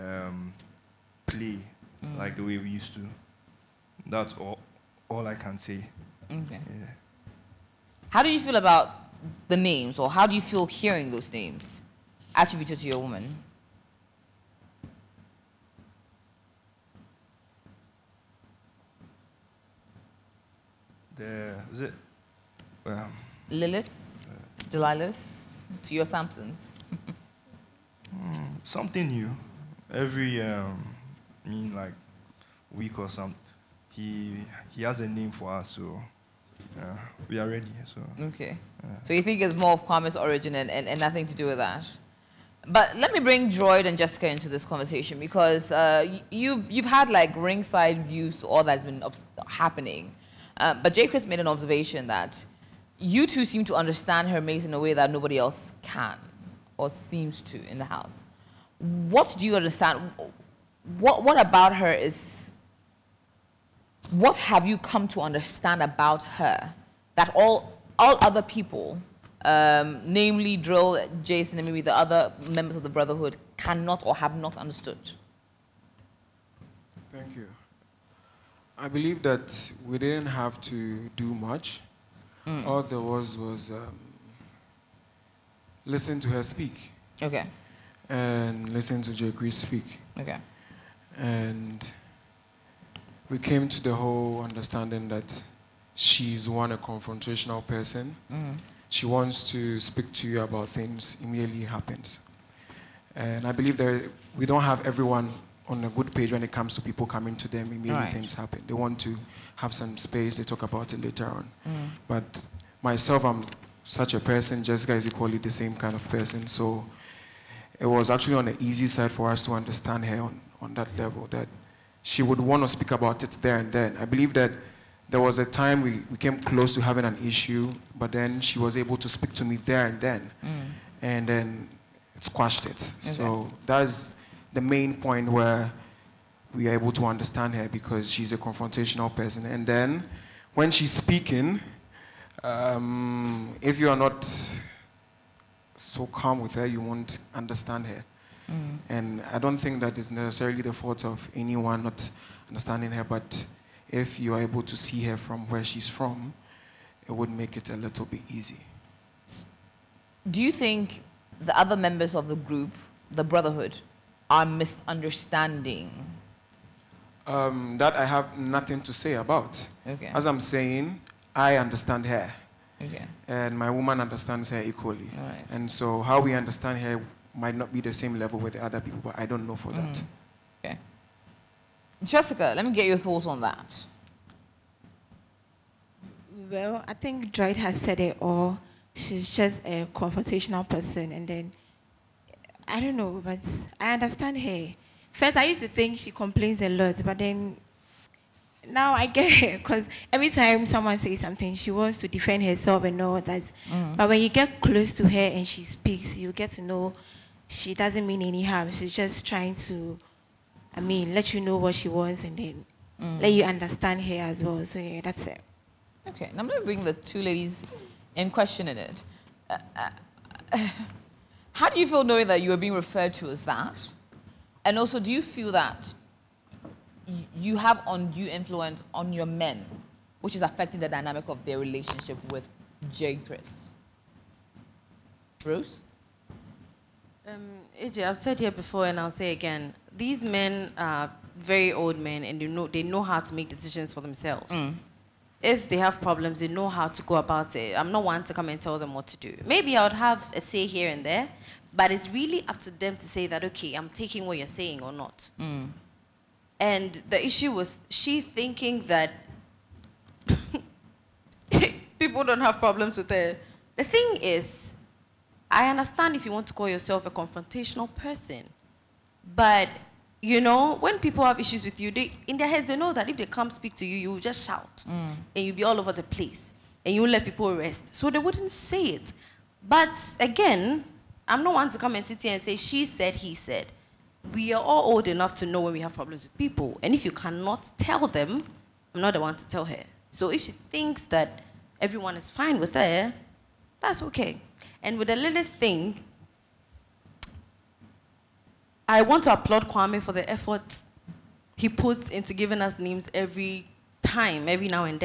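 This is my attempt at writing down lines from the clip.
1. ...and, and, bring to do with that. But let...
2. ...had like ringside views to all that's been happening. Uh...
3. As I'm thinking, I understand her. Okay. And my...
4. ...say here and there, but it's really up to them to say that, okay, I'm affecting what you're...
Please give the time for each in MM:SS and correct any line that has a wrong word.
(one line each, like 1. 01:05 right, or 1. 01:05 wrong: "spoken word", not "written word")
1. 00:40 wrong: "nothing", not "bring"
2. 00:46 right
3. 02:50 wrong: "saying", not "thinking"
4. 04:10 wrong: "taking", not "affecting".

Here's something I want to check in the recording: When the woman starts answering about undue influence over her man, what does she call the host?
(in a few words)
AJ.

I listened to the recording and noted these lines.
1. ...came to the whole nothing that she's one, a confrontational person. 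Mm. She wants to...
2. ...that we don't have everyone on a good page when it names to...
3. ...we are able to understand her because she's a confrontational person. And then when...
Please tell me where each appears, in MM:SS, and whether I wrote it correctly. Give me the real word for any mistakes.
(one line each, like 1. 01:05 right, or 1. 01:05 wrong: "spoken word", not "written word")
1. 01:33 wrong: "understanding", not "nothing"
2. 01:43 wrong: "comes", not "names"
3. 02:16 right.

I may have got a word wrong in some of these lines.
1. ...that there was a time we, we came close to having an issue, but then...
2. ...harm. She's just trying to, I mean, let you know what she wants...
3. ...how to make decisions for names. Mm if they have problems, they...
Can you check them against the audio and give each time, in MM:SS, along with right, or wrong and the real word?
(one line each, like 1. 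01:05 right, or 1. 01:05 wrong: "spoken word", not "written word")
1. 02:04 right
2. 03:28 right
3. 04:03 wrong: "themselves", not "names".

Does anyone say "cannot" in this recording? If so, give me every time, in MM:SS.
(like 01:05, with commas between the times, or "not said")
01:13, 04:47.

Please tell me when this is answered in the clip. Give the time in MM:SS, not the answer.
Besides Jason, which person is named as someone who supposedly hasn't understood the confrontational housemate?
01:10.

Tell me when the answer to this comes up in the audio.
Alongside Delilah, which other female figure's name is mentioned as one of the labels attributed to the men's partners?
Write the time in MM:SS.
00:23.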